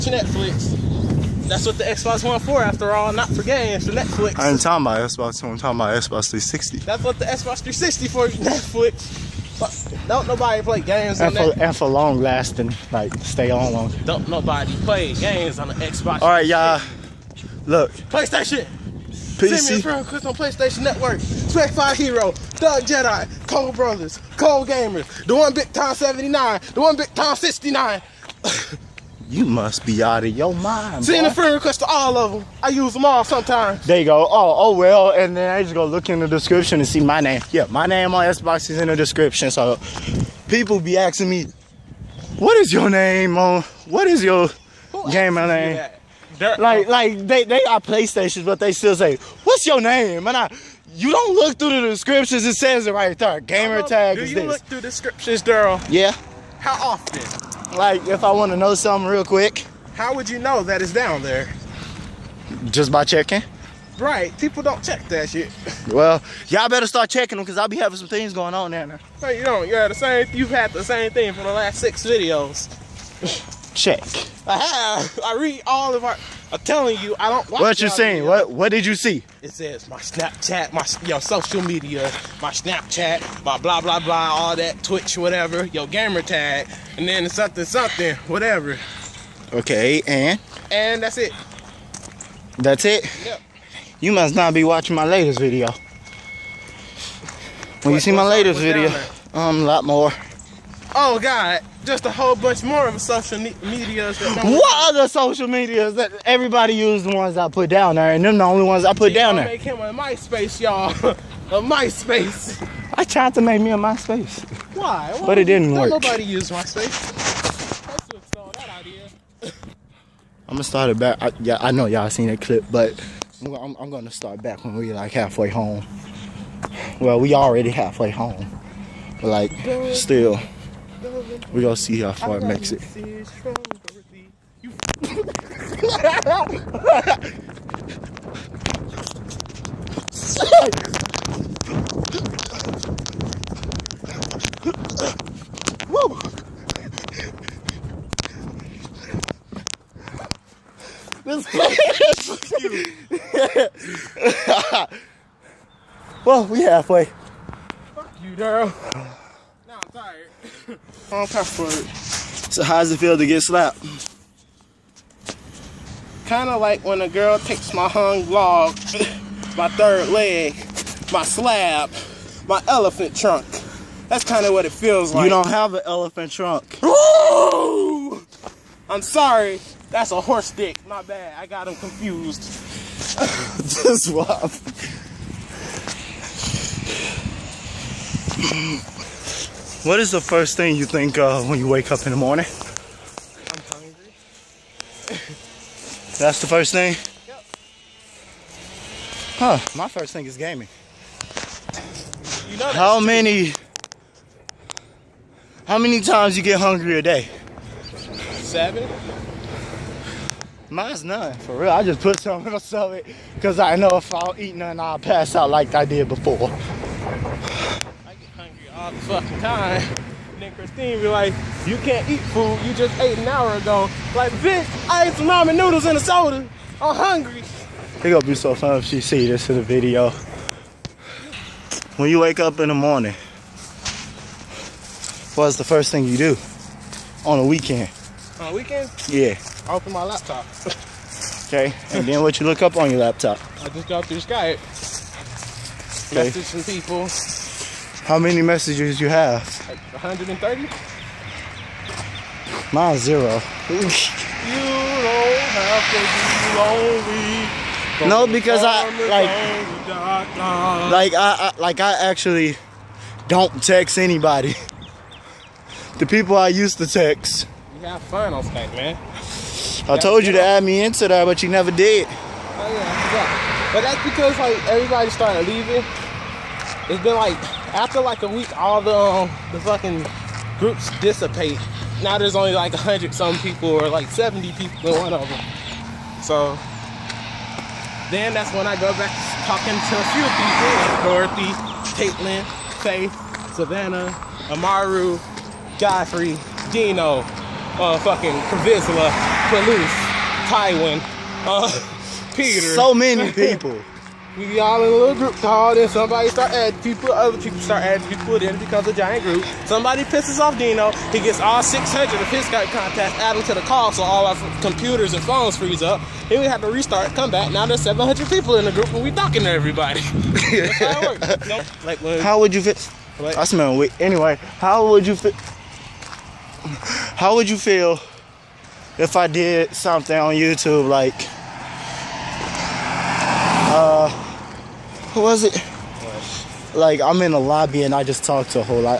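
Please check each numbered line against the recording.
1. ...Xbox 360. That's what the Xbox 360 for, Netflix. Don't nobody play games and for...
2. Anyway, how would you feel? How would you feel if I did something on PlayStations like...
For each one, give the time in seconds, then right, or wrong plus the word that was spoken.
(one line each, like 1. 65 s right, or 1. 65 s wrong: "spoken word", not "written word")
1. 5 s right
2. 324 s wrong: "YouTube", not "PlayStations".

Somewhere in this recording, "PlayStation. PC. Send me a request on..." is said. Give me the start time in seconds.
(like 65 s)
17 s.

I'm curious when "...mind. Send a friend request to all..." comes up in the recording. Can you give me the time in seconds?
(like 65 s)
30 s.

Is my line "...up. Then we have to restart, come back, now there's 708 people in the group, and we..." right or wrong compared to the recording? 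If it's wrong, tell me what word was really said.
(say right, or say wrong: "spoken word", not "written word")
wrong: "700", not "708".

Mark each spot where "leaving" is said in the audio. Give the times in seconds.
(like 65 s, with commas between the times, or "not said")
275 s.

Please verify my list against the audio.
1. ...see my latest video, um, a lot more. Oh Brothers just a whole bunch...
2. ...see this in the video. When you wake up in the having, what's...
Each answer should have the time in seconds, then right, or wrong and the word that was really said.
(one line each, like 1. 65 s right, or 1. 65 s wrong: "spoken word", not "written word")
1. 98 s wrong: "God", not "Brothers"
2. 229 s wrong: "morning", not "having".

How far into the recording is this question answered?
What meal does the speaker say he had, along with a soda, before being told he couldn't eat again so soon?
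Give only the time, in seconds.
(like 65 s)
225 s.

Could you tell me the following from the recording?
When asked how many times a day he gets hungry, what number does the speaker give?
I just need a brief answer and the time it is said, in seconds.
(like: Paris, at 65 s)
7, at 208 s.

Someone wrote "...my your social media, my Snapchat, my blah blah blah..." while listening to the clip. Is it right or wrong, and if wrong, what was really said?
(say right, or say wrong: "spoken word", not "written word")
right.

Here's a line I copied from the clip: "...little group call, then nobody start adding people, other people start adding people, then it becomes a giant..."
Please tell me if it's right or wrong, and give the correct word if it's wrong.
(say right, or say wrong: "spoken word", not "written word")
wrong: "somebody", not "nobody".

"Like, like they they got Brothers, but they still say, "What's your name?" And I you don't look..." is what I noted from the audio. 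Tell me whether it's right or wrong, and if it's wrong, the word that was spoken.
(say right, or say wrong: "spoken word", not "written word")
wrong: "PlayStations", not "Brothers".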